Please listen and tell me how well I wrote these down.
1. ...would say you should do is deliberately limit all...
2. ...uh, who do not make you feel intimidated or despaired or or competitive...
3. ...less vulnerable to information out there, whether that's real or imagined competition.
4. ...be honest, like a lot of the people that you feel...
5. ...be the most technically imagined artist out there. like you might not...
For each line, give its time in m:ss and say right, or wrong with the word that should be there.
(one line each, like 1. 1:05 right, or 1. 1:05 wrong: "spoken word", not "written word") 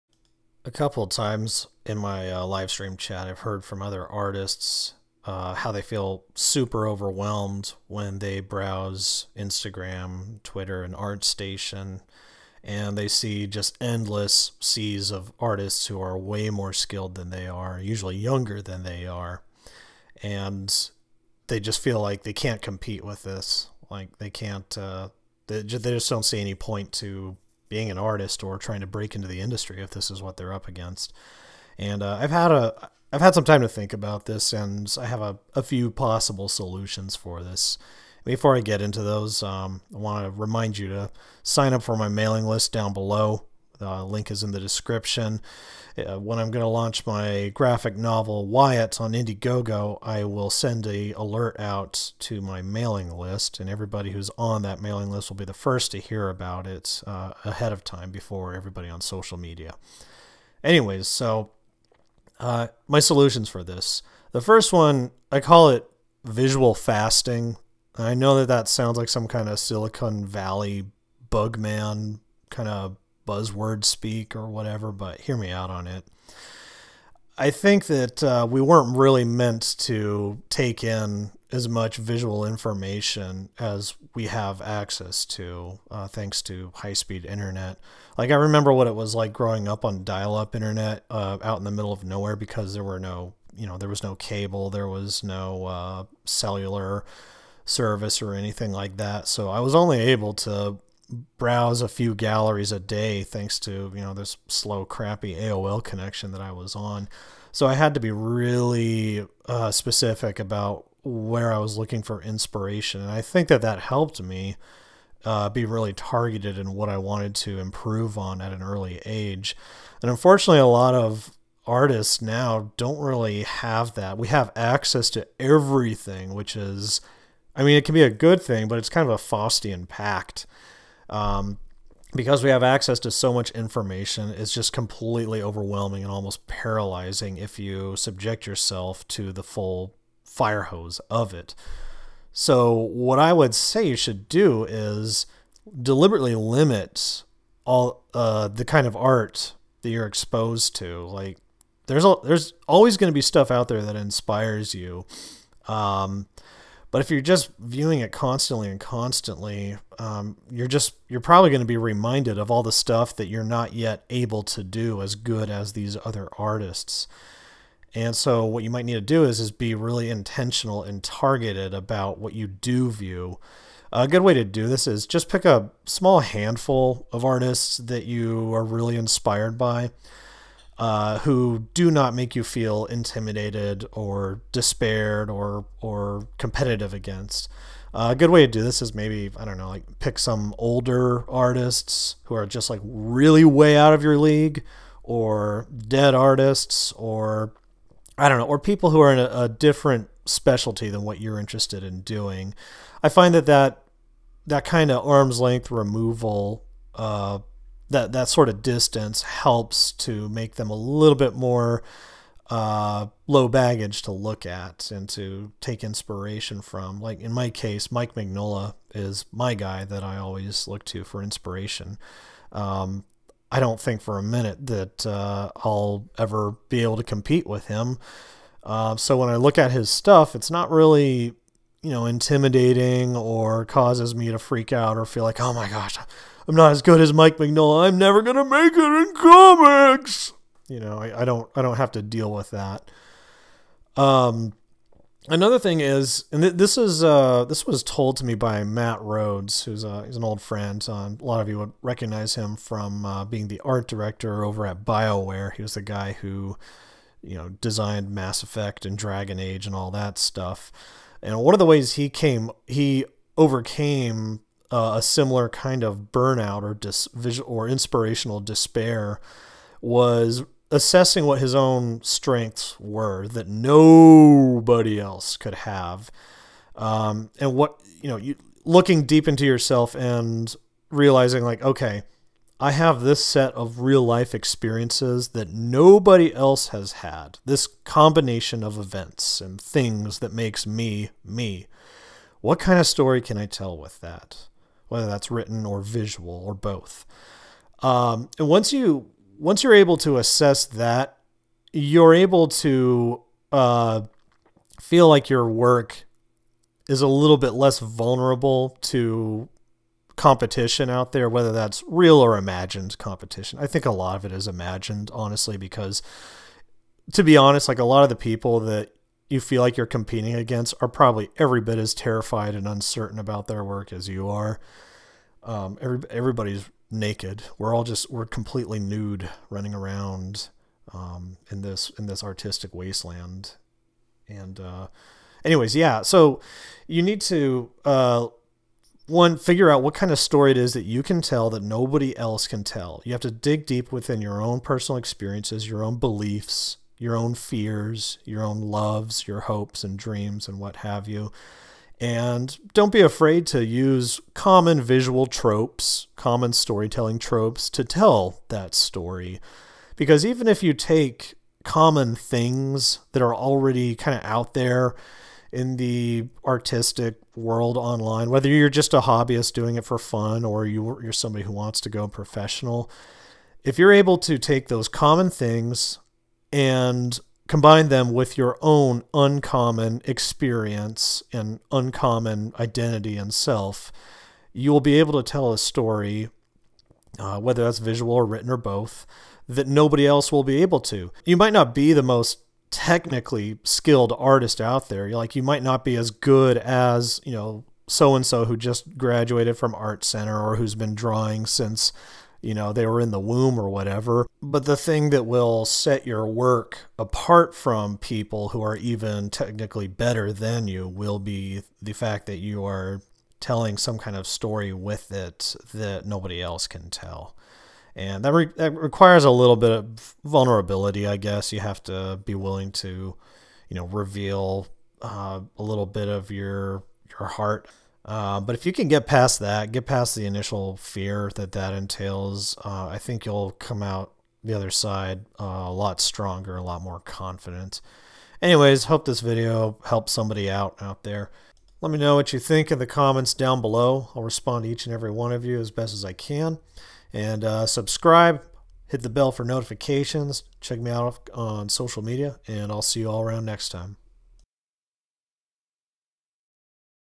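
1. 2:23 right
2. 3:00 right
3. 5:07 wrong: "competition", not "information"
4. 5:17 right
5. 6:31 wrong: "skilled", not "imagined".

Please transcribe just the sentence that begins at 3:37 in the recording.
Like in my case, Mike Mignola is my guy that I always look to for inspiration.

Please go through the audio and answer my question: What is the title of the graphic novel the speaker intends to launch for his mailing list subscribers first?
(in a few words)
WYIT.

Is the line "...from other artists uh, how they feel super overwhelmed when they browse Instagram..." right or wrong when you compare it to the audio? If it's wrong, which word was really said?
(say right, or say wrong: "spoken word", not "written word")
right.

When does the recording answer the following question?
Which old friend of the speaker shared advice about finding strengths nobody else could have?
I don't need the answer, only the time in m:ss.
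4:08.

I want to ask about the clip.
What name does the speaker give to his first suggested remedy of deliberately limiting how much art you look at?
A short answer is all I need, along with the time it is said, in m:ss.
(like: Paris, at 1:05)
Visual fasting, at 1:06.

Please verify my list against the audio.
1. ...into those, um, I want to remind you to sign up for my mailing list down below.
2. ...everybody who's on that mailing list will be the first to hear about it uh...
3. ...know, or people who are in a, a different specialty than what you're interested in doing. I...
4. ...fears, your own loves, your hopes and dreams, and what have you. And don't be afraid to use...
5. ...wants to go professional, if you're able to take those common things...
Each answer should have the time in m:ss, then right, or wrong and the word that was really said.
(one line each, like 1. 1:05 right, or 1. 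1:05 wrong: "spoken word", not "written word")
1. 0:38 right
2. 0:53 right
3. 3:18 right
4. 5:47 right
5. 6:11 right.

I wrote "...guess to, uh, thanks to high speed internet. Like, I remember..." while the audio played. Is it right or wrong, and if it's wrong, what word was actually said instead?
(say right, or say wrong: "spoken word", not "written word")
wrong: "access", not "guess".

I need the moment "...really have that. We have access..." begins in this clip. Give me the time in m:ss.
2:02.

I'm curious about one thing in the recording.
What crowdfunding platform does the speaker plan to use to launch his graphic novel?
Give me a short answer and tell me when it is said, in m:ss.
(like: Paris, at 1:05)
Indiegogo, at 0:49.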